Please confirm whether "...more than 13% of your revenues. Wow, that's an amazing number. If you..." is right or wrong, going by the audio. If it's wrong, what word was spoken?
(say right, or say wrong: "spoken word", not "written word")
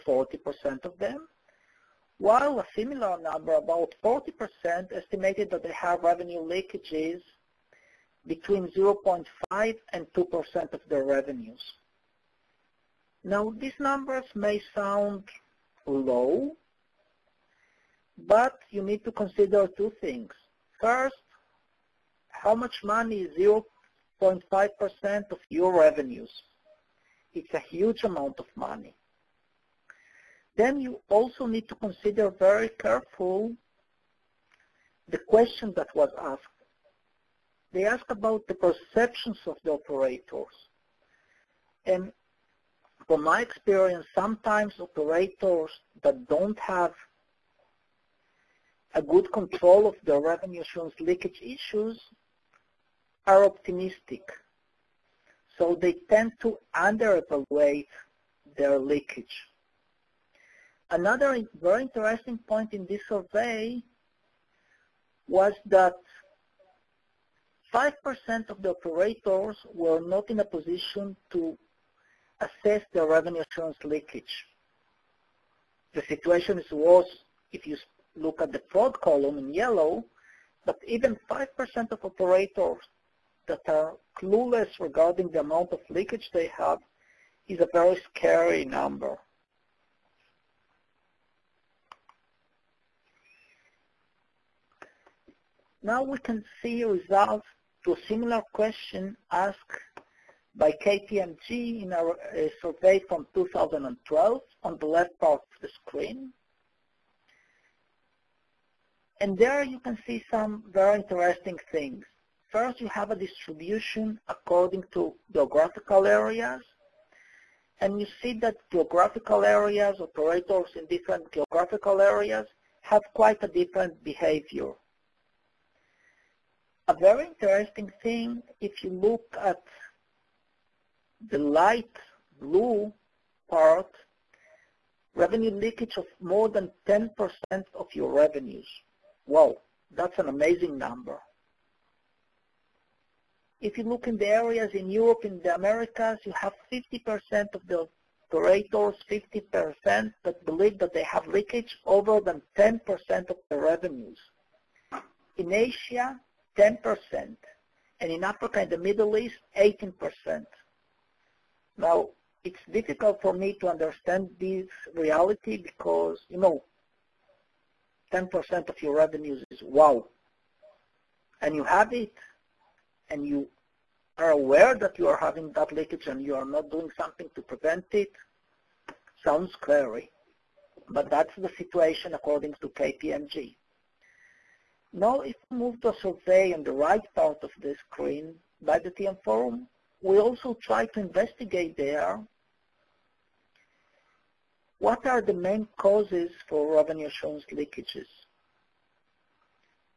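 wrong: "10", not "13".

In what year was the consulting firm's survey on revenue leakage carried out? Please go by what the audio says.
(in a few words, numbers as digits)
2012.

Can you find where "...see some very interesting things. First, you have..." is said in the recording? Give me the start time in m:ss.
1:50.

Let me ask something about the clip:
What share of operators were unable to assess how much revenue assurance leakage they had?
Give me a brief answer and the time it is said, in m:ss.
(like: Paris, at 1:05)
5%, at 1:07.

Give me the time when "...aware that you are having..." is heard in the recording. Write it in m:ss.
2:54.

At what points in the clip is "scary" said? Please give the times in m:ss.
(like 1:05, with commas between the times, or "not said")
1:28, 2:59.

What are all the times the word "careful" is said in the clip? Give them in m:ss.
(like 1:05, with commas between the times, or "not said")
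0:32.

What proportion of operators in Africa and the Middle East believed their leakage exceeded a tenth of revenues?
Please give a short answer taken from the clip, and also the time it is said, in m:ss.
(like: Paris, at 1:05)
18%, at 2:39.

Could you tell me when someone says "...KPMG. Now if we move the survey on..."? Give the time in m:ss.
3:02.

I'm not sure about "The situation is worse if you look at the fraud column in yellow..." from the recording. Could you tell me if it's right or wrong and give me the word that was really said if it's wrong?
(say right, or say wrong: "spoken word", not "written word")
right.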